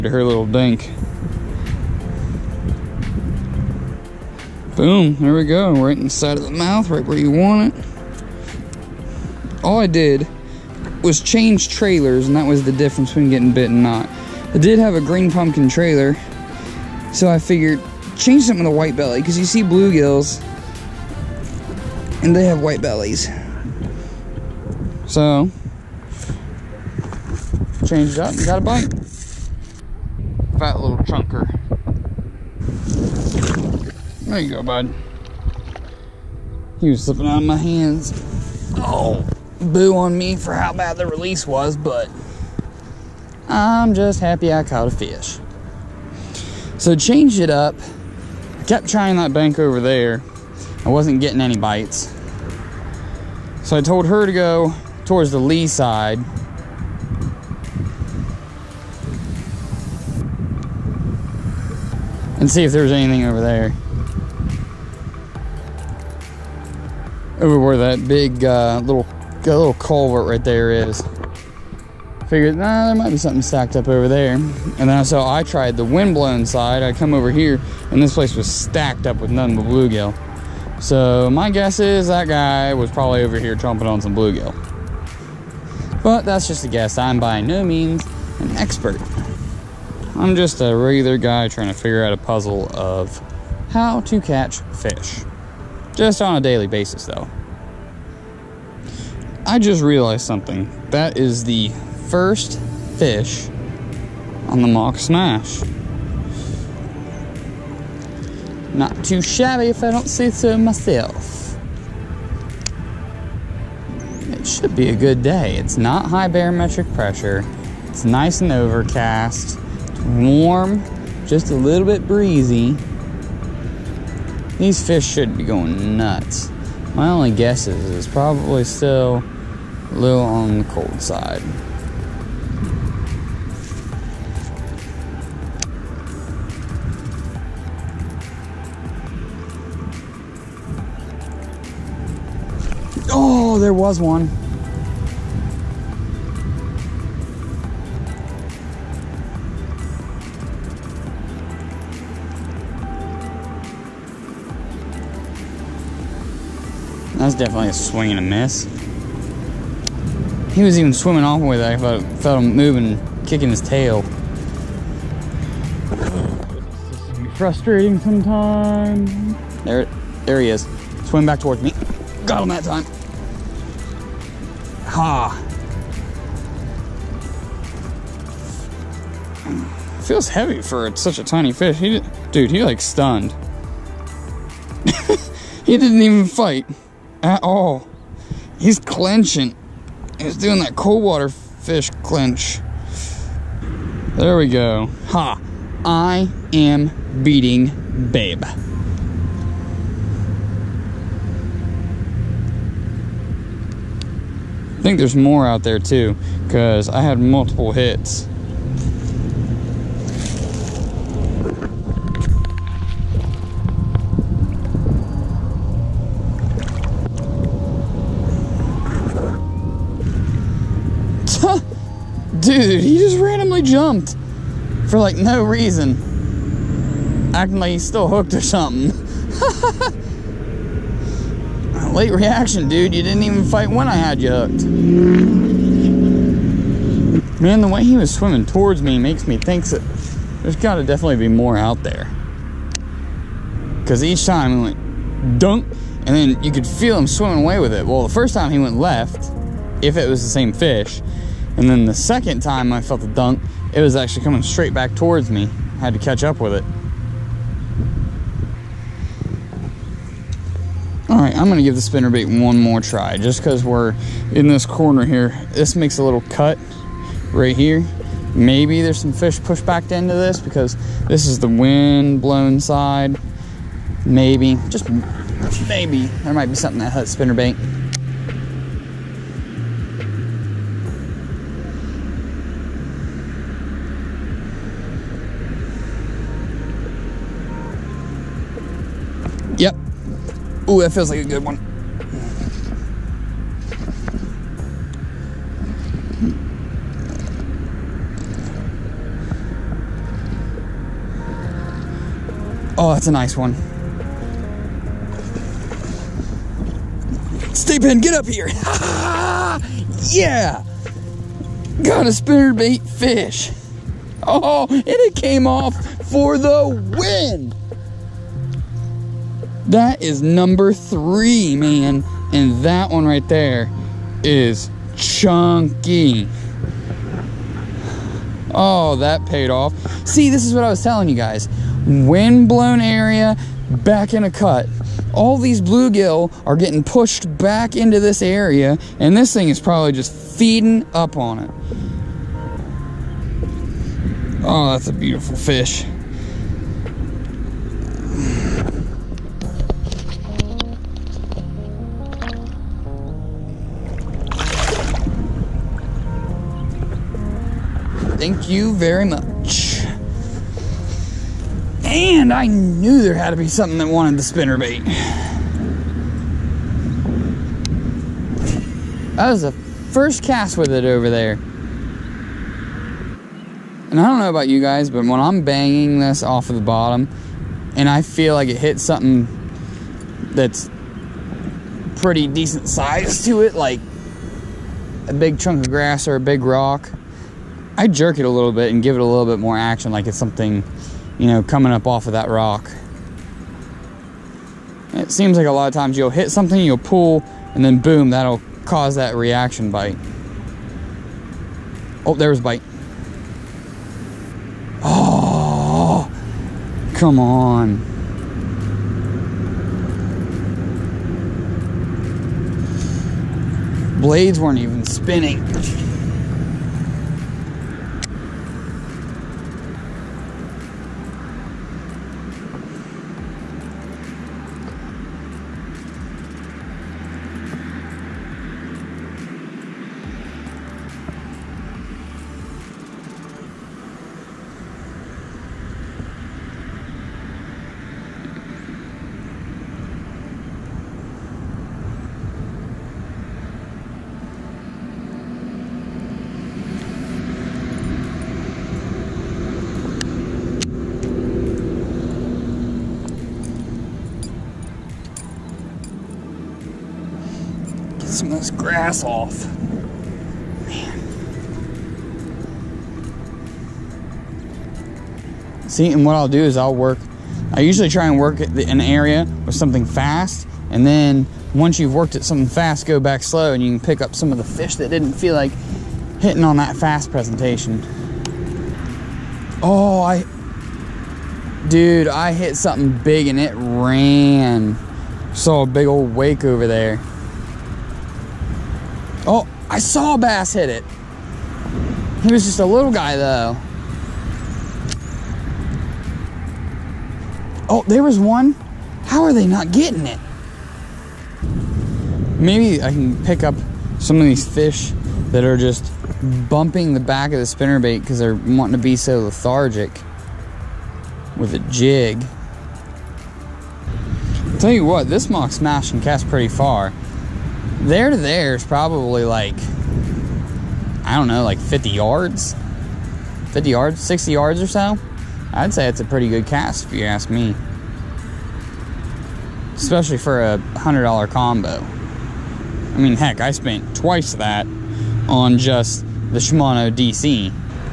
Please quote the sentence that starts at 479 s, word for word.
Oh, I, dude, I hit something big and it ran.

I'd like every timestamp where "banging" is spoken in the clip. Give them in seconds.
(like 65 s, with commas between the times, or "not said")
375 s.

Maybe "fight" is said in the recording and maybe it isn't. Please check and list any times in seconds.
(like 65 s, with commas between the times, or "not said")
186 s, 233 s.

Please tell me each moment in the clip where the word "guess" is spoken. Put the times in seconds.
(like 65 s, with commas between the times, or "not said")
81 s, 86 s, 127 s.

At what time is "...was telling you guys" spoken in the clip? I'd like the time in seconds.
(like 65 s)
330 s.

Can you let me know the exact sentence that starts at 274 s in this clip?
Maybe, just maybe, there might be something that hut spinner bait.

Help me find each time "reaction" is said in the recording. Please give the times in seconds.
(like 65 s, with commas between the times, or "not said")
232 s, 399 s.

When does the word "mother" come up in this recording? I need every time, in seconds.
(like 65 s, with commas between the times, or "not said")
not said.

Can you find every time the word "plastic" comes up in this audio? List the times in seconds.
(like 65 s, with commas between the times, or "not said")
not said.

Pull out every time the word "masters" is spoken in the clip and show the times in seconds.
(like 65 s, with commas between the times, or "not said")
not said.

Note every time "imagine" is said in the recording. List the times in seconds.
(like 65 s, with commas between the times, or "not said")
not said.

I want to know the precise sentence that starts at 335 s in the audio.
All these bluegill are getting pushed back into this area, and this thing is probably just feeding up on it.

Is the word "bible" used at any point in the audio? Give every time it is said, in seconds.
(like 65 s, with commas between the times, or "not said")
not said.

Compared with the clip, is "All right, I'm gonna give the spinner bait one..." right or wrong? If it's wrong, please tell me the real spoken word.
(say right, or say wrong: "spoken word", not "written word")
right.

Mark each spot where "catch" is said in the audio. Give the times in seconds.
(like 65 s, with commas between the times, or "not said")
94 s, 255 s.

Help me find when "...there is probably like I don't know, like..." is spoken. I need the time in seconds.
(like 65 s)
518 s.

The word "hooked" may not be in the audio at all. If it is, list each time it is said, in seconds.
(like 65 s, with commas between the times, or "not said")
228 s, 234 s.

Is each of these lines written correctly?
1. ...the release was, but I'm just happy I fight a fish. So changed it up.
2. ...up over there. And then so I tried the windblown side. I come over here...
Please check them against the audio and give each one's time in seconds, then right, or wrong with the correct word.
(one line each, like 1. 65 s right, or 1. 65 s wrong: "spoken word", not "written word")
1. 40 s wrong: "caught", not "fight"
2. 73 s right.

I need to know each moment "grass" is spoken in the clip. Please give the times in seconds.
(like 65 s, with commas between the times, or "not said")
385 s, 458 s.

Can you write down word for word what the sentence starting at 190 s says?
He's doing that cold water fish clinch.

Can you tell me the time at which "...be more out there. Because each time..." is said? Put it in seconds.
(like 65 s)
241 s.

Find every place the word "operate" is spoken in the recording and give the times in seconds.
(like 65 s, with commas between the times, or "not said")
not said.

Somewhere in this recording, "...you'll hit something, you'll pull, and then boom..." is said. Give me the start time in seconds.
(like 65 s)
395 s.